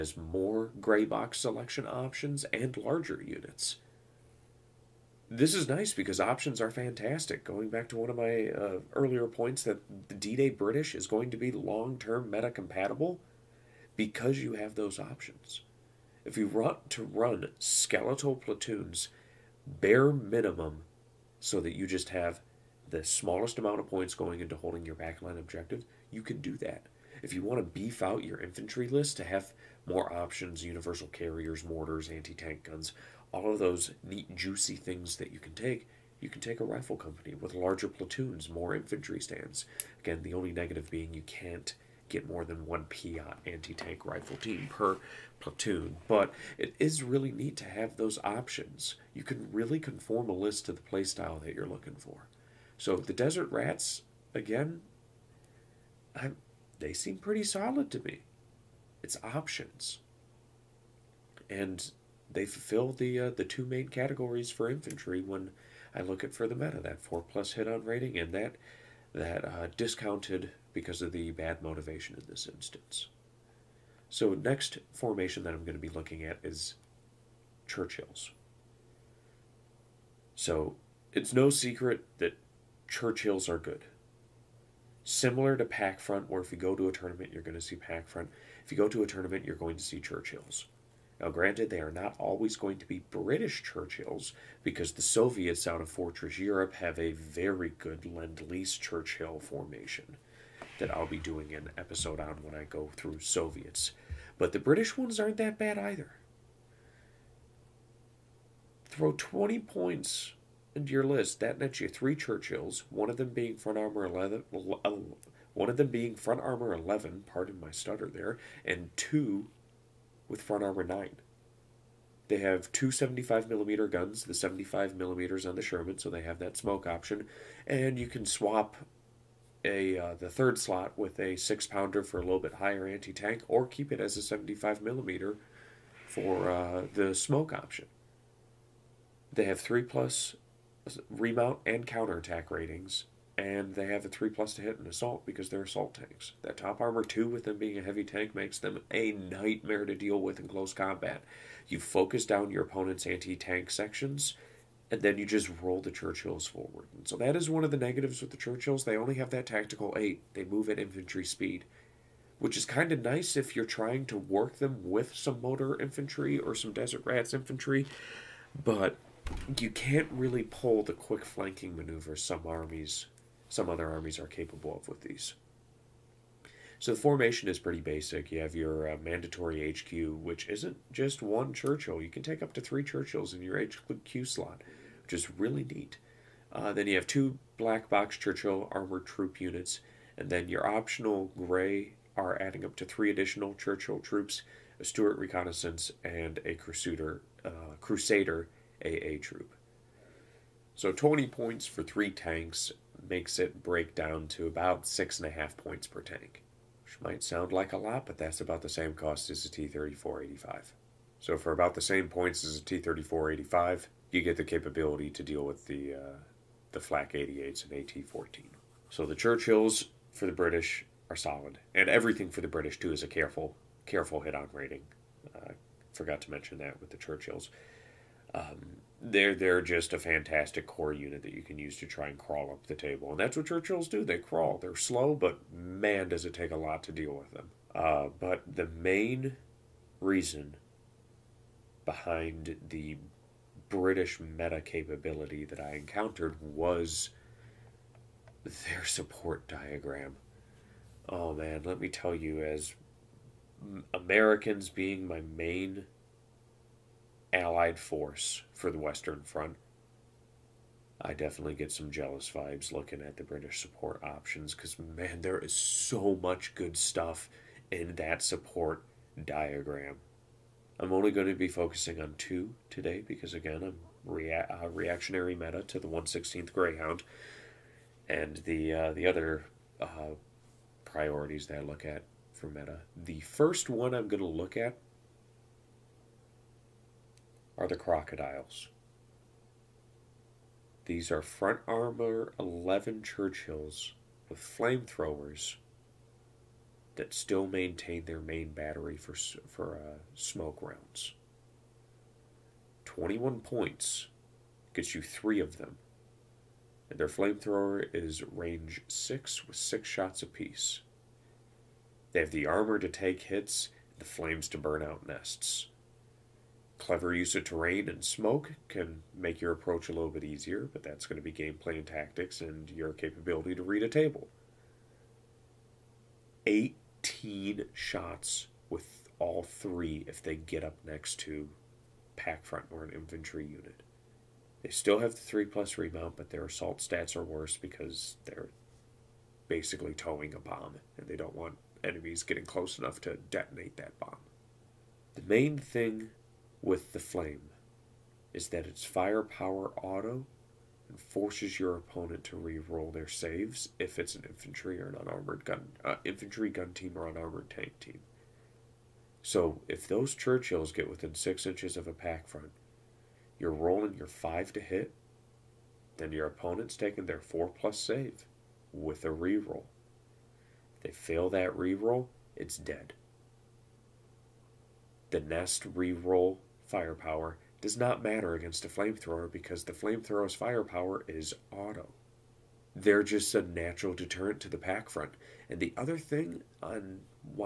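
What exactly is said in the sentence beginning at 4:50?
These are front armor 11 Churchills with flamethrowers that still maintain their main battery for, for uh, smoke rounds.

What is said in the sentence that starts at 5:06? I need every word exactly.
And their flamethrower is range 6 with 6 shots apiece.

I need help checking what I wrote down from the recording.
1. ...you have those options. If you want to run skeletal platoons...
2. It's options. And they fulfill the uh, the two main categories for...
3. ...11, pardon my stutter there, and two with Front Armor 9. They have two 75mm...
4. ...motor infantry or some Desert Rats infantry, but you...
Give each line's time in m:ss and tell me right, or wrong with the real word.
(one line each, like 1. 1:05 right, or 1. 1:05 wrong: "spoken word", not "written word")
1. 0:14 right
2. 0:59 right
3. 1:56 right
4. 2:45 right.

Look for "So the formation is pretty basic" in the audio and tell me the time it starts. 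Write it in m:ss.
2:56.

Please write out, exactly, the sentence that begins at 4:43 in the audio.
The first one I'm going to look at are the crocodiles.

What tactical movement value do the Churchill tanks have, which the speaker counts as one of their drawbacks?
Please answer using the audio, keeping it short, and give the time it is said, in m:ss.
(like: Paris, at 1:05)
8, at 2:39.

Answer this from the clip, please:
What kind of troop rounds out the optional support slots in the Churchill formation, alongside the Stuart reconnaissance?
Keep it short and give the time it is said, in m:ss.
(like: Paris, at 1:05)
Crusader AA troop, at 3:17.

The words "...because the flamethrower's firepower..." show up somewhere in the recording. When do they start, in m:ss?
6:19.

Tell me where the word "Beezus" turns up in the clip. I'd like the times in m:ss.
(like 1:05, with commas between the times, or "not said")
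not said.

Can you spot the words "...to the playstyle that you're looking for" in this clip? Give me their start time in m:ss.
0:50.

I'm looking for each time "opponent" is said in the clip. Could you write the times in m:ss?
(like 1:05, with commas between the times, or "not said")
2:32, 5:51, 6:06.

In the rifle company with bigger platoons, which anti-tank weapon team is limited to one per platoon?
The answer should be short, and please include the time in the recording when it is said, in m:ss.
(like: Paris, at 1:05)
Piat anti-tank rifle team, at 0:42.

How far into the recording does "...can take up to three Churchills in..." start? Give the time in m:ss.
3:02.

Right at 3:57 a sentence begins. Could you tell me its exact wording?
Uh, but the main reason behind the British meta capability that I encountered was their support diagram.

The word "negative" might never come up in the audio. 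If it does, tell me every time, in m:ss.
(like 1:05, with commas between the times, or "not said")
0:40, 2:37.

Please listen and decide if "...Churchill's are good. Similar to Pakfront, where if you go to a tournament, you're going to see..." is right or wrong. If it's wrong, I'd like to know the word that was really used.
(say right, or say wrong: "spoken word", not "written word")
right.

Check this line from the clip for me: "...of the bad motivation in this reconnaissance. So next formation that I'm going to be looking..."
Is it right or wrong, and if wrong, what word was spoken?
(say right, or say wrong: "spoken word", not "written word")
wrong: "instance", not "reconnaissance".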